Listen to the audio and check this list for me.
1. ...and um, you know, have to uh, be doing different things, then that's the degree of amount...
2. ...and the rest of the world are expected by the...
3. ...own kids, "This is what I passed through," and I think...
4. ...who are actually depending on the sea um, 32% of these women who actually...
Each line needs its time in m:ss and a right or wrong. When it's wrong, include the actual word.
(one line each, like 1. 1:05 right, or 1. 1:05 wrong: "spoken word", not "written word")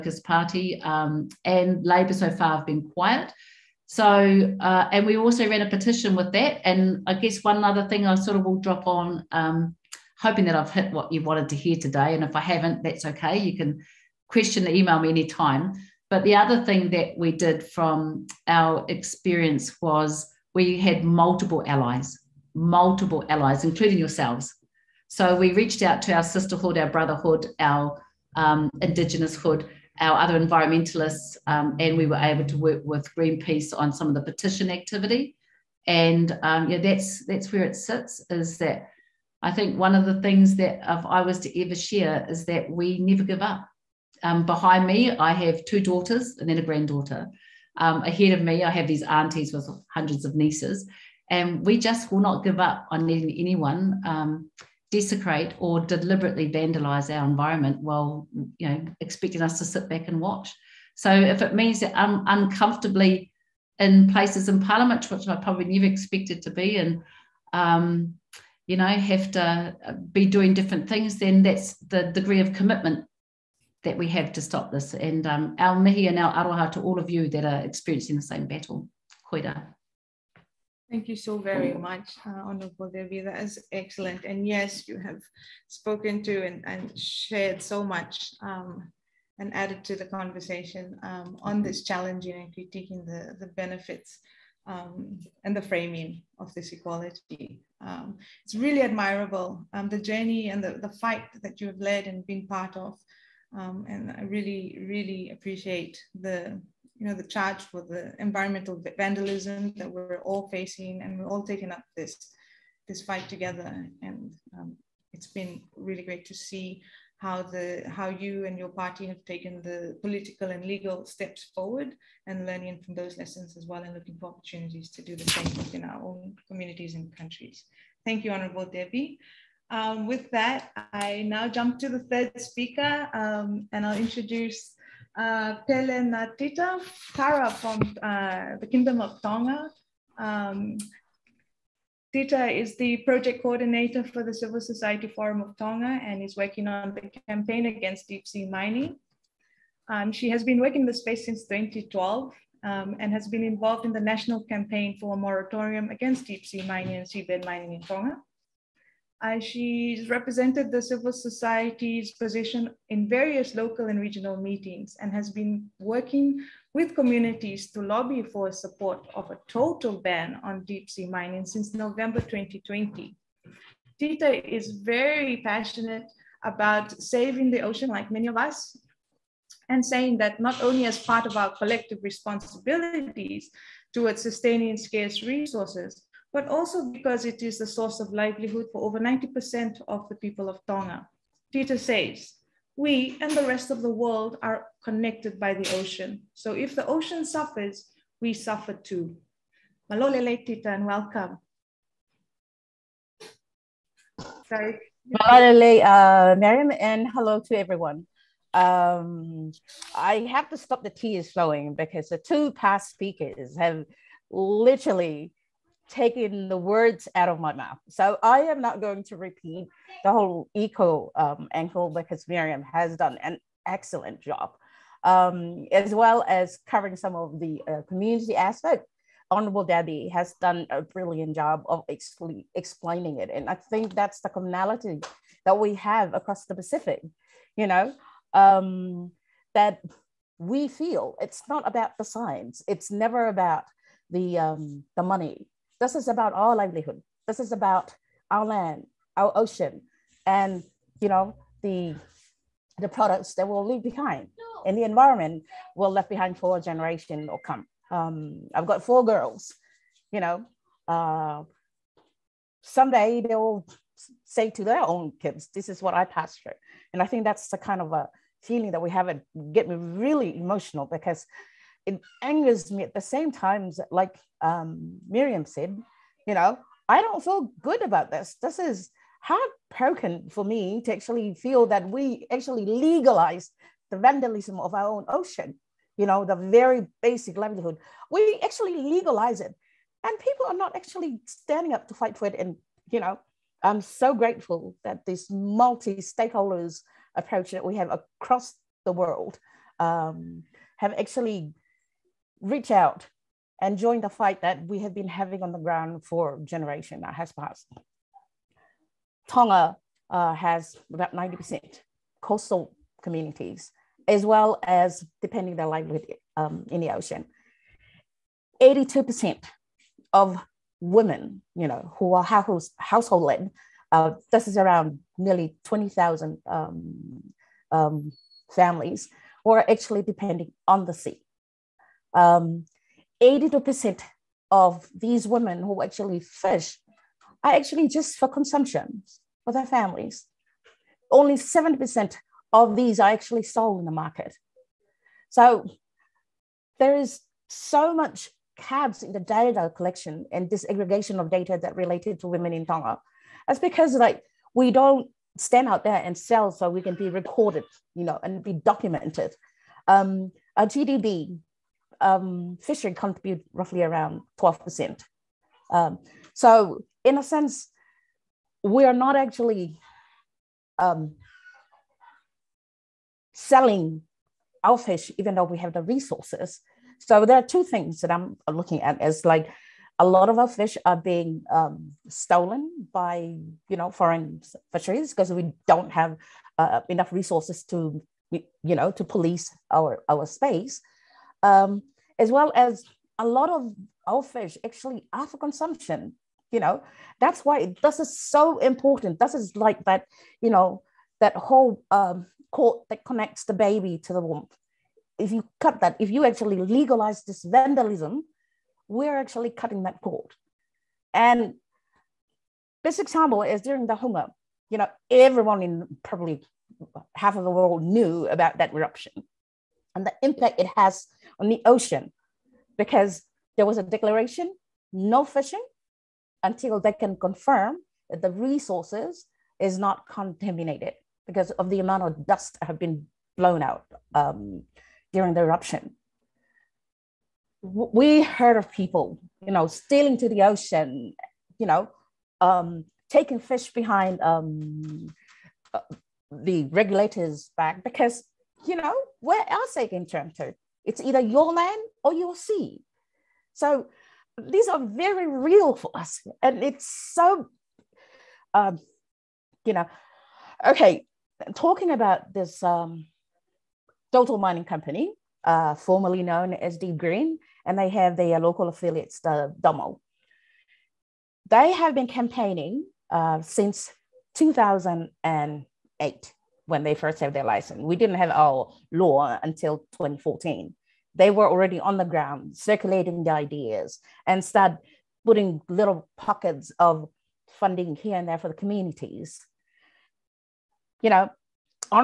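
1. 1:06 wrong: "commitment", not "amount"
2. 3:13 wrong: "connected", not "expected"
3. 4:24 right
4. 5:29 wrong: "82", not "32".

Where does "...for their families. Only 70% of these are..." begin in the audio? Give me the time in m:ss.
5:39.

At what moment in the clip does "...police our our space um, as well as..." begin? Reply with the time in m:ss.
6:29.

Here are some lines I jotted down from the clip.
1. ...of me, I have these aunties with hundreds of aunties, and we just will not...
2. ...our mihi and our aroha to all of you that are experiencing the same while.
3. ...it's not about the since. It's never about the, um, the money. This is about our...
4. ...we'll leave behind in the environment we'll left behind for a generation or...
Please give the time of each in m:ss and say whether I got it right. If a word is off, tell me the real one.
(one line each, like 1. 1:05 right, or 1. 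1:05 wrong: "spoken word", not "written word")
1. 0:48 wrong: "nieces", not "aunties"
2. 1:15 wrong: "battle", not "while"
3. 4:01 wrong: "science", not "since"
4. 4:13 right.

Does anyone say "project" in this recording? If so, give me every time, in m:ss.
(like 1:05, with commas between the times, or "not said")
2:22.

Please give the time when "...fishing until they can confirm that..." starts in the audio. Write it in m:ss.
7:05.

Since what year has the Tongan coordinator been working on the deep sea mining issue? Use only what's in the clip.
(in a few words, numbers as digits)
2012.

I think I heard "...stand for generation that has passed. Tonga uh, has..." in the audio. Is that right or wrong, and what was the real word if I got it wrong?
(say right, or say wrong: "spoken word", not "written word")
wrong: "ground", not "stand".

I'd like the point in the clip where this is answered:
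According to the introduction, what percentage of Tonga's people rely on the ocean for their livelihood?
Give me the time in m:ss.
3:08.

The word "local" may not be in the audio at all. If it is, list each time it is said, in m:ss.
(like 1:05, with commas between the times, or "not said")
2:43, 7:48.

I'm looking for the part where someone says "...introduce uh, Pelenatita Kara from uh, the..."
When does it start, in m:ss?
2:13.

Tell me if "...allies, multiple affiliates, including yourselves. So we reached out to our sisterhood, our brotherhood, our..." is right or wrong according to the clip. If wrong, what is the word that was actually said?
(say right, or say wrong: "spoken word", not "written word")
wrong: "allies", not "affiliates".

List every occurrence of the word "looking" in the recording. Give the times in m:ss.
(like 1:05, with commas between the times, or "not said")
2:03, 6:18.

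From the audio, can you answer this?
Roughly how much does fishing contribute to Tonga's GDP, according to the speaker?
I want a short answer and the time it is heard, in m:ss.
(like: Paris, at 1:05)
12%, at 6:04.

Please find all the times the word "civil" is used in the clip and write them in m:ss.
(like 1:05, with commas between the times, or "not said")
2:24, 2:40.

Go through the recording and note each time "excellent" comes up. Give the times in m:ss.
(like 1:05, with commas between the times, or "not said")
1:23, 3:43.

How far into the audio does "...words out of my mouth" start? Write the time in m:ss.
3:36.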